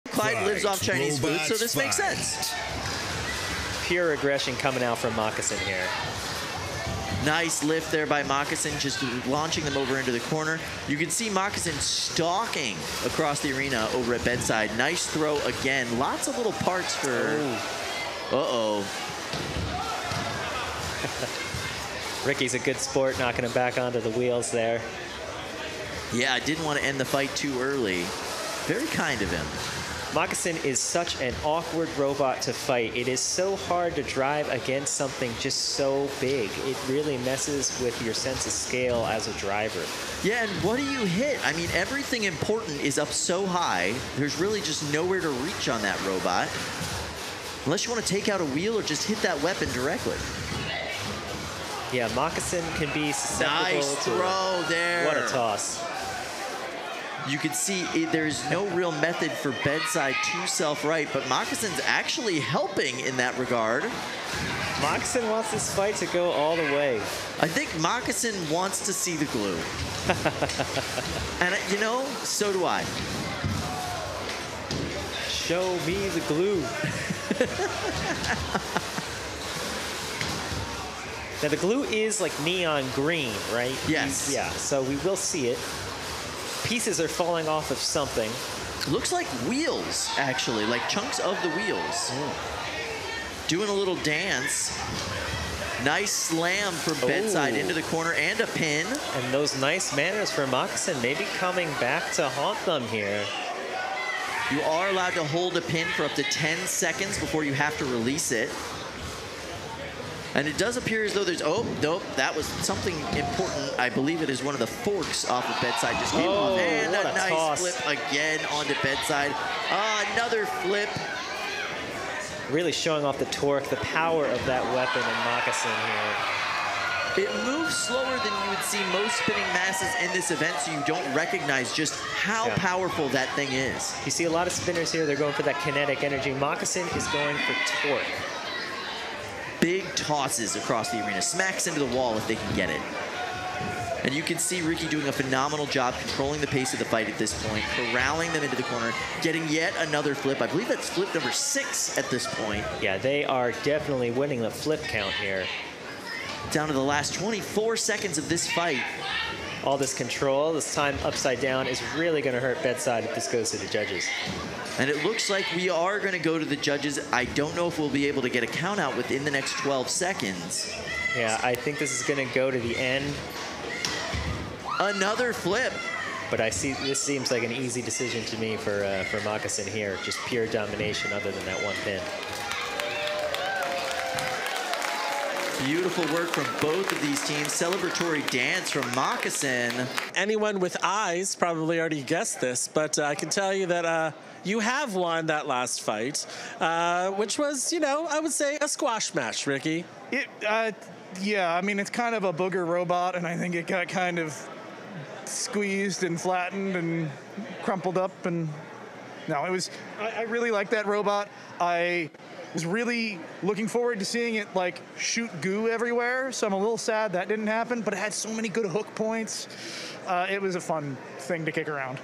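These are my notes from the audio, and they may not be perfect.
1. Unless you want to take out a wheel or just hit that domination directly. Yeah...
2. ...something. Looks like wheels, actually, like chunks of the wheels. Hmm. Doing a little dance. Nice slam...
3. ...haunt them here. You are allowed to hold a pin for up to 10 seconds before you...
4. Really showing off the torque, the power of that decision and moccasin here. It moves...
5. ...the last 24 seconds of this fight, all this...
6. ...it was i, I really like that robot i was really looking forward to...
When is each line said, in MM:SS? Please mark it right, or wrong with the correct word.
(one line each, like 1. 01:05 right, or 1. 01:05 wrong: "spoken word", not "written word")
1. 00:47 wrong: "weapon", not "domination"
2. 01:27 right
3. 01:42 right
4. 02:02 wrong: "weapon", not "decision"
5. 02:36 right
6. 03:29 right.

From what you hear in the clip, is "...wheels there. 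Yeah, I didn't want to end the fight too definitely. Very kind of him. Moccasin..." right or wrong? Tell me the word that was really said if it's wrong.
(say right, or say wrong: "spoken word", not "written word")
wrong: "early", not "definitely".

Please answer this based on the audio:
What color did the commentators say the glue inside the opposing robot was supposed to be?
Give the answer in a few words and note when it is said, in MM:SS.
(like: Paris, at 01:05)
neon green, at 01:22.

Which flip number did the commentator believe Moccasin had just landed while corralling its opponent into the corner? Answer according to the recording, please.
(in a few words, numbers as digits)
6.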